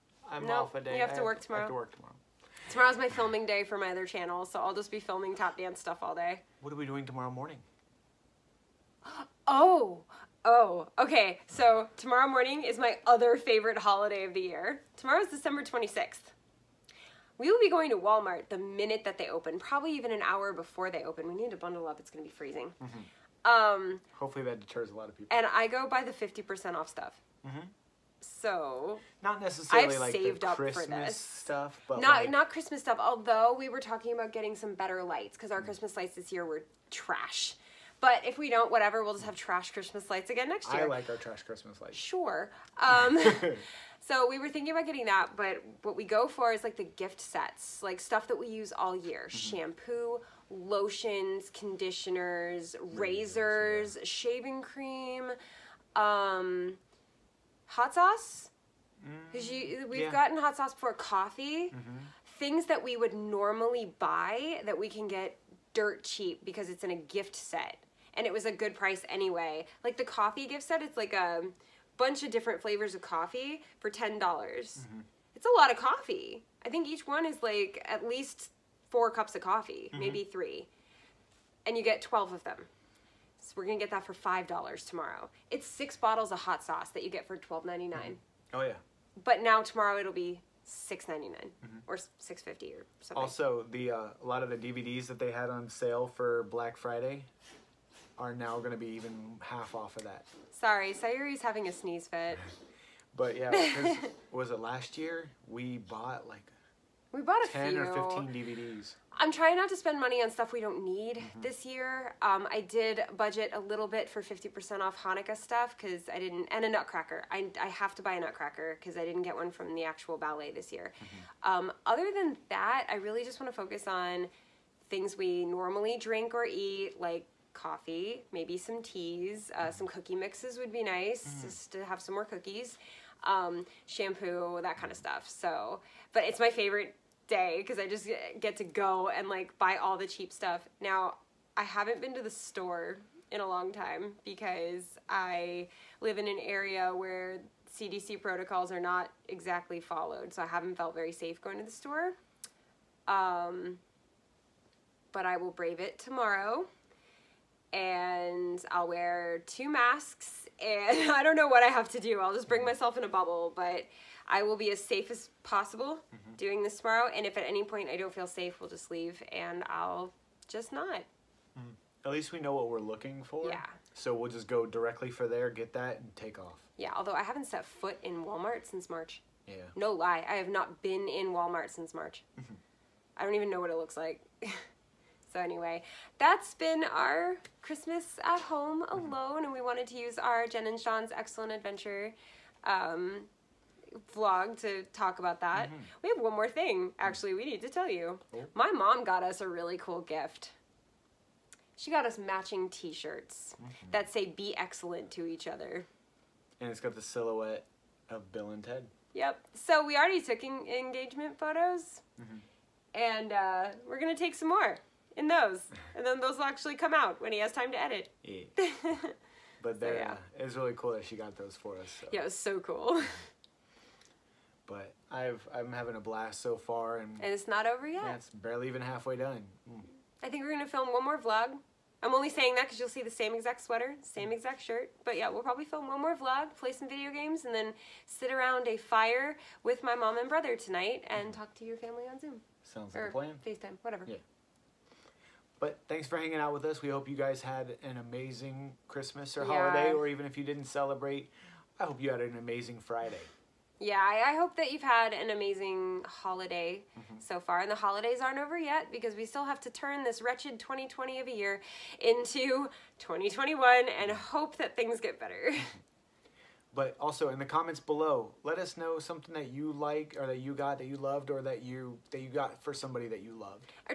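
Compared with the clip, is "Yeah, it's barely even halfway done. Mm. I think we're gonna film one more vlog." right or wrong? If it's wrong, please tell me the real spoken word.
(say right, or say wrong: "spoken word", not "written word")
right.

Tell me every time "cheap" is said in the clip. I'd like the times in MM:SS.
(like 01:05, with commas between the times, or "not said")
01:06, 02:20.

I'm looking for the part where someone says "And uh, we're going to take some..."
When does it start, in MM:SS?
03:33.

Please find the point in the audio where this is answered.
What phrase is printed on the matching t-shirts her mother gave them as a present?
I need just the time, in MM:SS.
03:24.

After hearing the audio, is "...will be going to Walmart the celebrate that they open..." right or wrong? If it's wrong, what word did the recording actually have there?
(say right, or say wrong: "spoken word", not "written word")
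wrong: "minute", not "celebrate".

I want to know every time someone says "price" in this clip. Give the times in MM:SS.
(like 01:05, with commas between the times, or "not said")
01:08.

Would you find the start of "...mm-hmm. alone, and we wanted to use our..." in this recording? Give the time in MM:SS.
03:08.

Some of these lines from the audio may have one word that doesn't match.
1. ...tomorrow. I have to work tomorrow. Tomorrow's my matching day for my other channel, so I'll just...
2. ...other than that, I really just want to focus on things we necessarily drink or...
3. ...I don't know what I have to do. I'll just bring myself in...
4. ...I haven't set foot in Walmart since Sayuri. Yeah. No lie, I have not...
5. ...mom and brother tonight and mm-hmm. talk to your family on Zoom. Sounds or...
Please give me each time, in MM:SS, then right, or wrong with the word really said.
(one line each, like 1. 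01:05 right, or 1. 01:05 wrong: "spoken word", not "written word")
1. 00:01 wrong: "filming", not "matching"
2. 02:01 wrong: "normally", not "necessarily"
3. 02:41 right
4. 02:57 wrong: "March", not "Sayuri"
5. 03:59 right.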